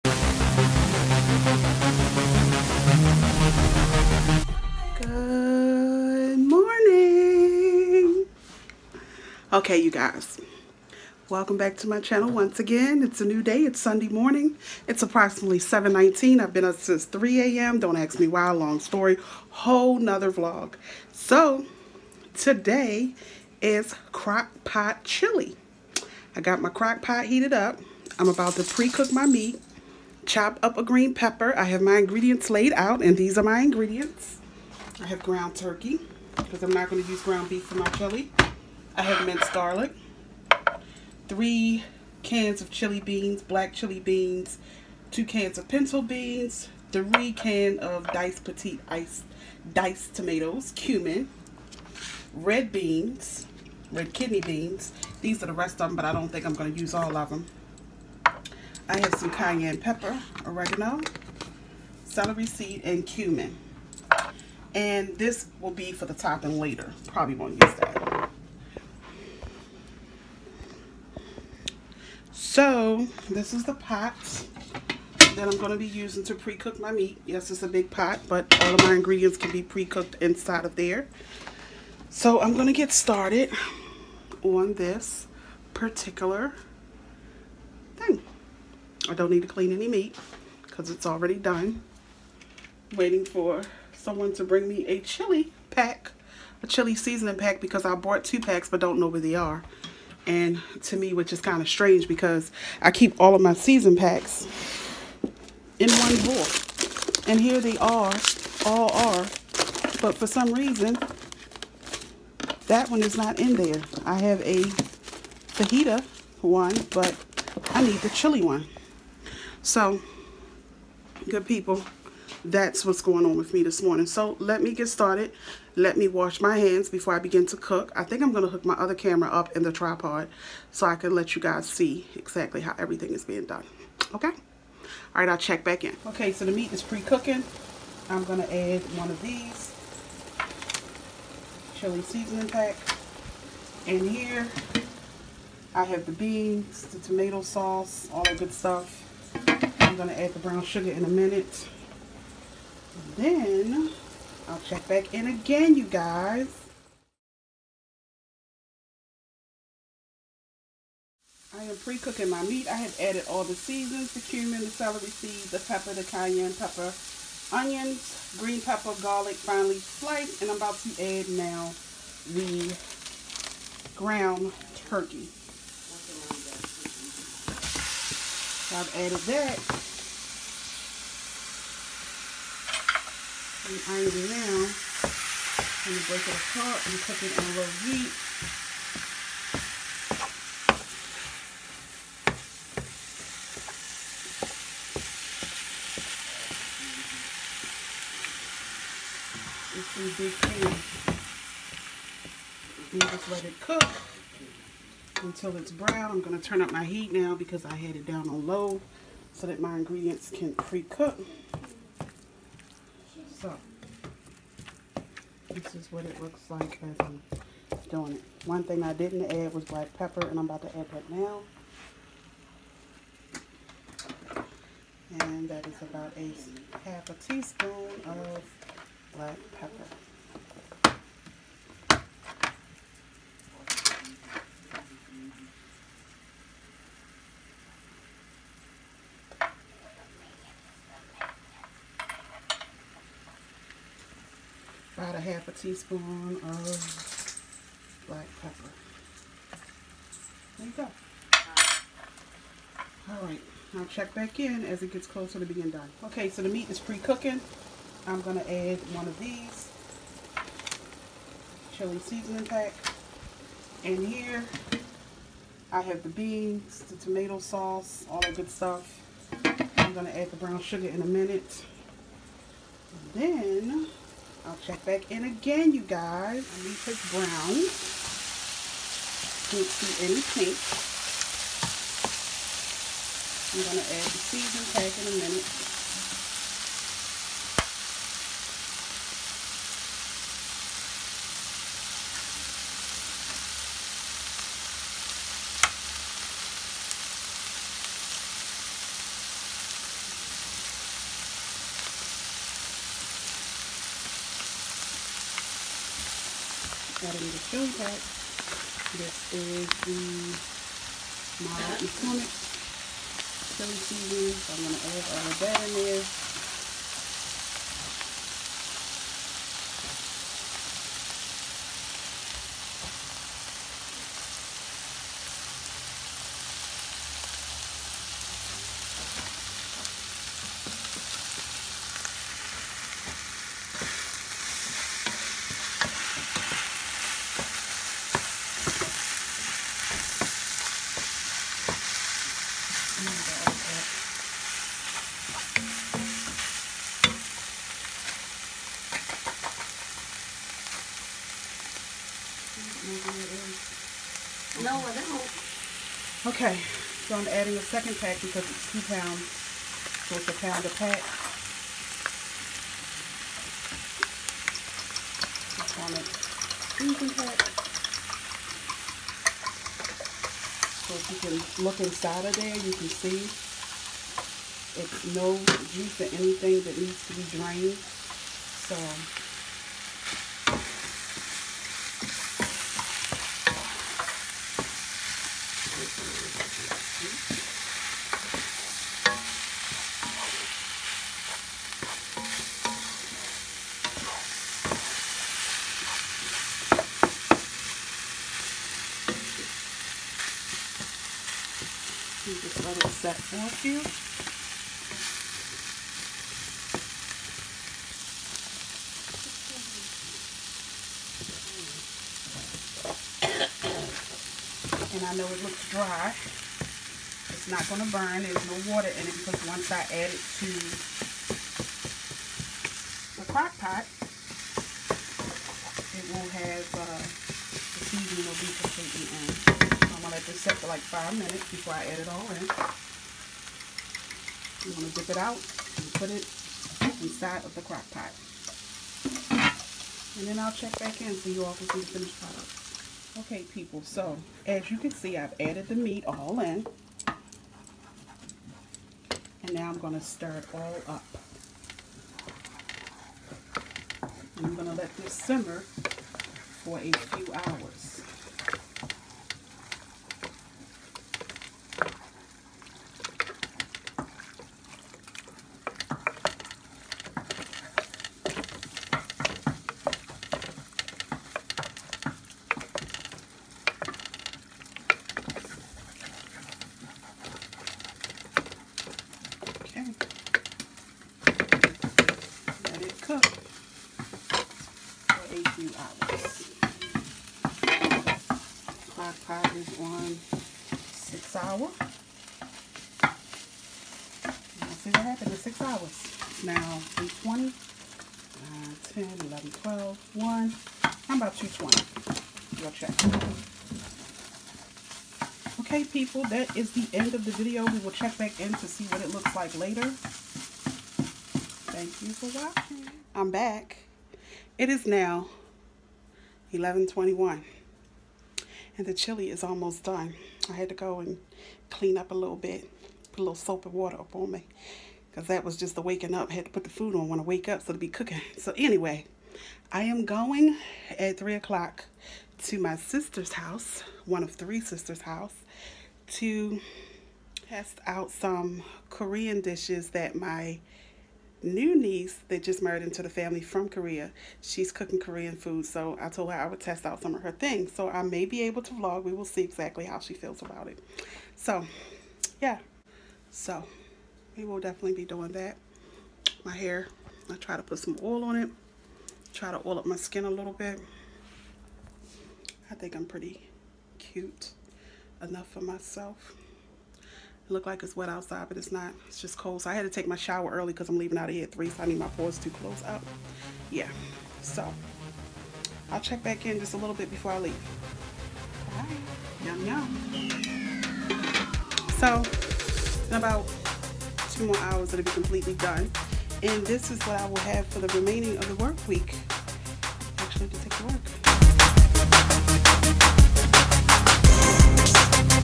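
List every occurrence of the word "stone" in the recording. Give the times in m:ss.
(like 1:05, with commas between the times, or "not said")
5:07, 5:13.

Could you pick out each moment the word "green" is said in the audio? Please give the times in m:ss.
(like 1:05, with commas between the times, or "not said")
0:30, 2:48.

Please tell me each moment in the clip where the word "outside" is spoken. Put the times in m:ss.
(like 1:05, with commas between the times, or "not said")
9:28.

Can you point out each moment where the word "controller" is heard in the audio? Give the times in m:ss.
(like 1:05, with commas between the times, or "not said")
not said.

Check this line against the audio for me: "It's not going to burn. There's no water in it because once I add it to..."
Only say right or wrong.
right.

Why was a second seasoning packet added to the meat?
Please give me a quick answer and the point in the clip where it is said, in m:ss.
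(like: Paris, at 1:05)
It's two pounds, at 5:58.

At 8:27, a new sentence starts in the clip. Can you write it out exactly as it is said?
We will check back in to see what it looks like later.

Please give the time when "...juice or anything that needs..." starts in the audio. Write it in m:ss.
6:15.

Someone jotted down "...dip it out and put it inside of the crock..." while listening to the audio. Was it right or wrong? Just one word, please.
right.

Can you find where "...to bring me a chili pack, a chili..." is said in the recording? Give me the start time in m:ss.
1:34.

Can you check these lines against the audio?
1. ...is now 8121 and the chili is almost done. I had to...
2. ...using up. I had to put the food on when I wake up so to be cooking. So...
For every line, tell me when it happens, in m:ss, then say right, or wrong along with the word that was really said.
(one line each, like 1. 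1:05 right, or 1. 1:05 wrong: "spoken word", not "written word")
1. 8:34 wrong: "1121", not "8121"
2. 8:45 wrong: "waking", not "using".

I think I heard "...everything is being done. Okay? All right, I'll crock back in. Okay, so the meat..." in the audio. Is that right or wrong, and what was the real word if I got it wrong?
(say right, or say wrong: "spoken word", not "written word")
wrong: "check", not "crock".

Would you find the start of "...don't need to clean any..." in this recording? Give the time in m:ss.
1:29.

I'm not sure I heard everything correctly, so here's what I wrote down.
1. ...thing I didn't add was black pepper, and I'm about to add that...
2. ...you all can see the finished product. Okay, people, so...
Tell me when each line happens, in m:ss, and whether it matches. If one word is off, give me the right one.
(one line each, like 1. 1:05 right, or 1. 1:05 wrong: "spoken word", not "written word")
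1. 3:38 right
2. 7:21 right.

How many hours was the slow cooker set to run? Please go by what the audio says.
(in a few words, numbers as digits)
6.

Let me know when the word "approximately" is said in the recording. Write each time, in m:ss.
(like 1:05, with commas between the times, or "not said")
0:15.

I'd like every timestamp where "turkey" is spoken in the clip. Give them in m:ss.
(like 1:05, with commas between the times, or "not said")
0:35, 2:54.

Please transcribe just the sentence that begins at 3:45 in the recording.
And that is about a half a teaspoon of black pepper.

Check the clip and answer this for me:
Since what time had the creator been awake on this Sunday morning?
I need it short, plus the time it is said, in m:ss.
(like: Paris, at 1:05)
3 a.m., at 0:17.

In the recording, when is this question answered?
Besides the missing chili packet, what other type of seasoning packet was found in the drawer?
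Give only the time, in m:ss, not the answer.
1:55.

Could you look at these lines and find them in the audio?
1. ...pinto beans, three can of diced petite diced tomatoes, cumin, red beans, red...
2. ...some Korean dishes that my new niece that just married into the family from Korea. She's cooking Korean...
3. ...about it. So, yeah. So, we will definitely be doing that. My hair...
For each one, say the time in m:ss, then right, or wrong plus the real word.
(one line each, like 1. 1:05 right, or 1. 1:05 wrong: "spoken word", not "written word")
1. 0:45 right
2. 8:58 right
3. 9:10 right.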